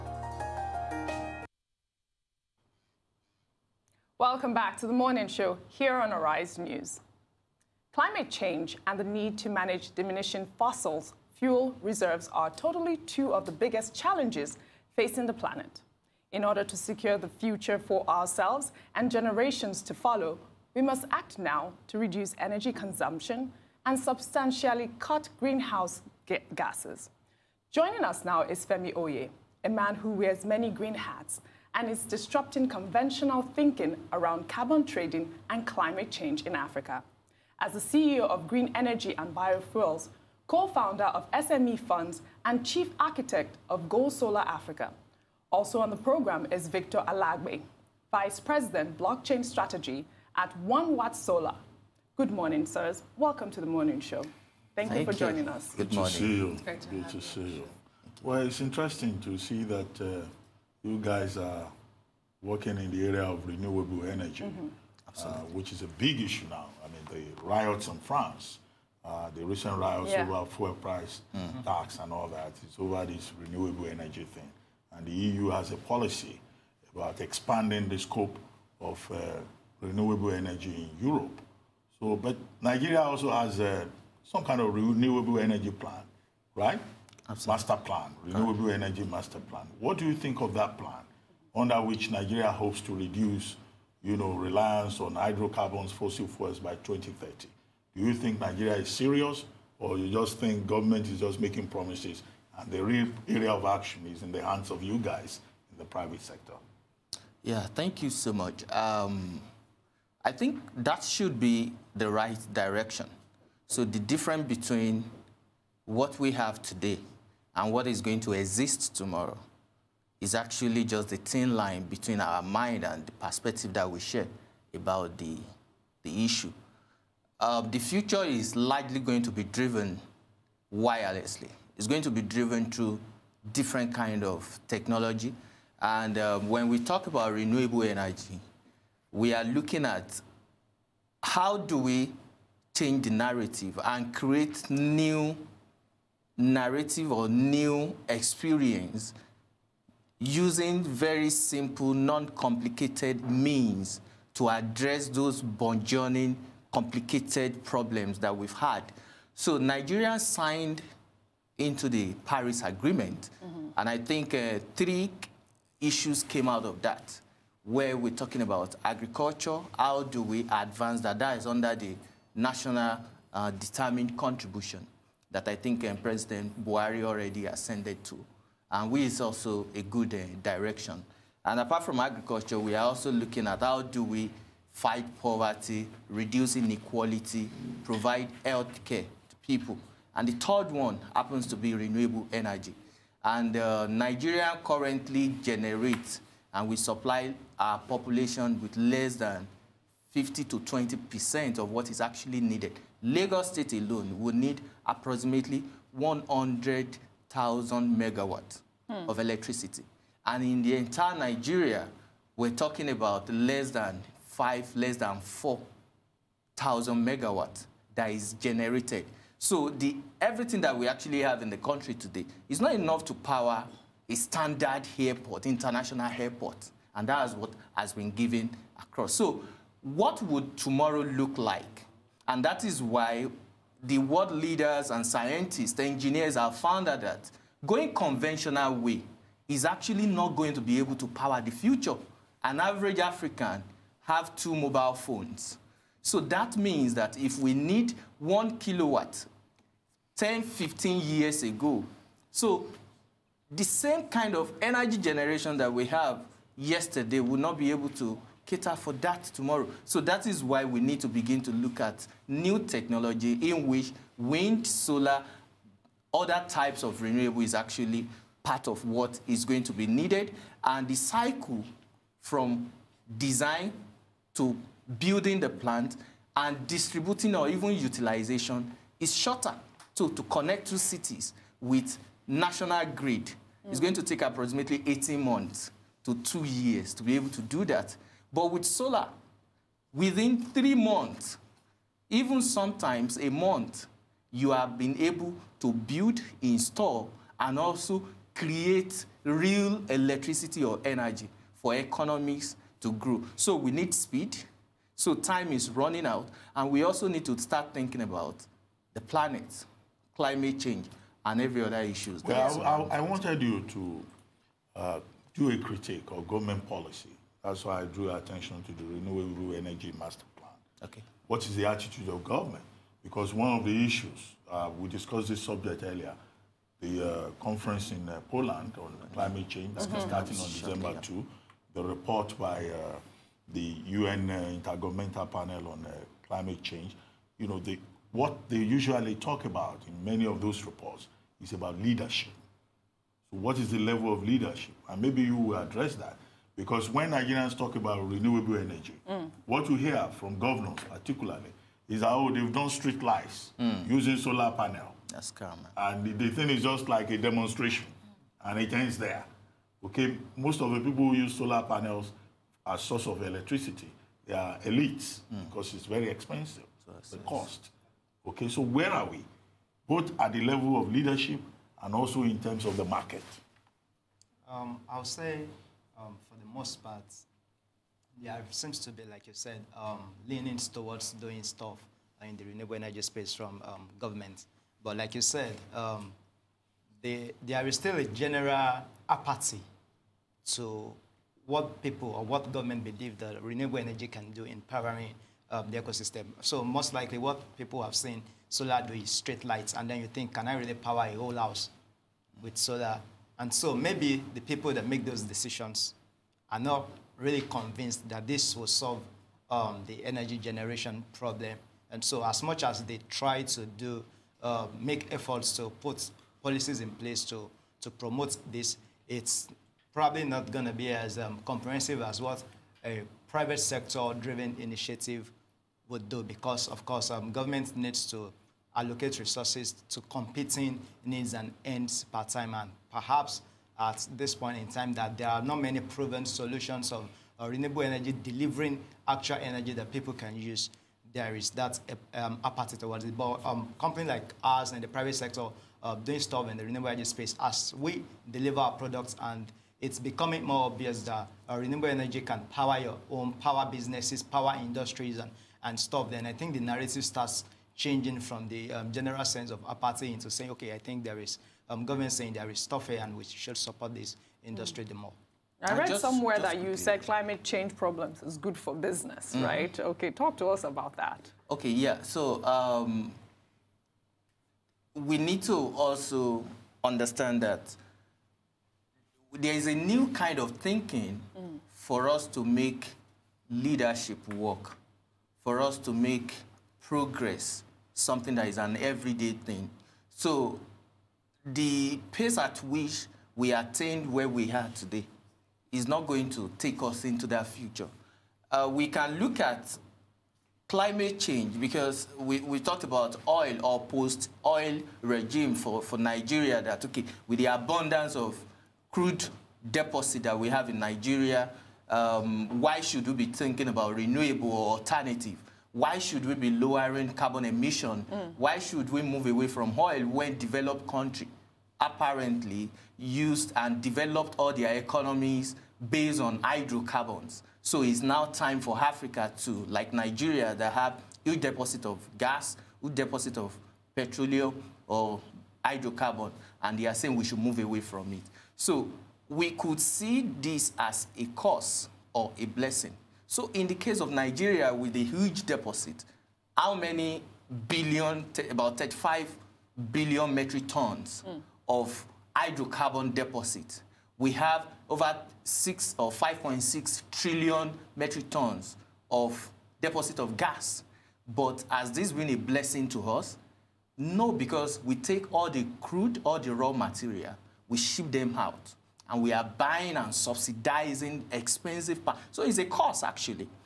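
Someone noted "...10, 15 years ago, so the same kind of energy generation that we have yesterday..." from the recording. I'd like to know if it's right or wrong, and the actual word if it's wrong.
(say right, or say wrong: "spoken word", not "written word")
right.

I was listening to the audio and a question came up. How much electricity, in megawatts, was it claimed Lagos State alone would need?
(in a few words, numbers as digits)
100,000 megawatts.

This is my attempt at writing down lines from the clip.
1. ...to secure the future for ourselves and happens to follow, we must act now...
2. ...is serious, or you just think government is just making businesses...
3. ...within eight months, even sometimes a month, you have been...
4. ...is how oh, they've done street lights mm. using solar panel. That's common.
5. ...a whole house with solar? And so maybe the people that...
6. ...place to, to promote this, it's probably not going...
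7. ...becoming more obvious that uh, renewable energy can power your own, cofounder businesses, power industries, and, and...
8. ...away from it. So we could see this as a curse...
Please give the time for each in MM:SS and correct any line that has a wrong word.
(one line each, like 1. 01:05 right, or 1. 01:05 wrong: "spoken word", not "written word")
1. 00:16 wrong: "generations", not "happens"
2. 01:38 wrong: "promises", not "businesses"
3. 04:49 wrong: "three", not "eight"
4. 05:51 right
5. 06:41 right
6. 06:56 right
7. 07:29 wrong: "power", not "cofounder"
8. 08:57 right.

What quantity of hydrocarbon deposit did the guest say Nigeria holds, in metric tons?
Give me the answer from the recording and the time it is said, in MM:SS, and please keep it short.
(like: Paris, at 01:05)
35 billion, at 09:08.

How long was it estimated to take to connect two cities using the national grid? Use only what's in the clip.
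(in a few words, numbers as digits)
18 months to 2 years.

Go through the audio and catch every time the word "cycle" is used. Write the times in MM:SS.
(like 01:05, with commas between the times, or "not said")
04:30.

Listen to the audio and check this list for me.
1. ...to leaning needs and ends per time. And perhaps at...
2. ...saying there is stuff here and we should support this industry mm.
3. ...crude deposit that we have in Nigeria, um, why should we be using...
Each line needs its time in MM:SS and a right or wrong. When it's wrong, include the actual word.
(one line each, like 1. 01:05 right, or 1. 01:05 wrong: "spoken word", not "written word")
1. 07:09 wrong: "competing", not "leaning"
2. 07:42 right
3. 08:28 wrong: "thinking", not "using".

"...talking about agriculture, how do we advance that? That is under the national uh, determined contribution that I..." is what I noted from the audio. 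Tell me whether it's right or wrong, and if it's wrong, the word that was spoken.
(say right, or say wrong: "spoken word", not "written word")
right.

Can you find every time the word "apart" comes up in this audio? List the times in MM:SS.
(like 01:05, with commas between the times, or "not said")
03:01.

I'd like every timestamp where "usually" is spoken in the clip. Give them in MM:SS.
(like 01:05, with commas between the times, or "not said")
05:38.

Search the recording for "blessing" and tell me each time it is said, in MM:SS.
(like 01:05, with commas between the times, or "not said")
09:02, 09:22.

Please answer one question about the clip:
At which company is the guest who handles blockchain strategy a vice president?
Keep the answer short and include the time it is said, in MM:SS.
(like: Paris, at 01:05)
One Watt Solar, at 00:50.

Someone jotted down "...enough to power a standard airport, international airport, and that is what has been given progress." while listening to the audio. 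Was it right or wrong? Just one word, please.
wrong.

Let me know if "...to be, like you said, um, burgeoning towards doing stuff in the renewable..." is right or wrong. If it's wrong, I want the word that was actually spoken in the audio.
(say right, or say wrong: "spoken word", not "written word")
wrong: "leaning", not "burgeoning".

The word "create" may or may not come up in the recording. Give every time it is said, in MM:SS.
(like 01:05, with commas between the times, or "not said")
02:24, 04:58.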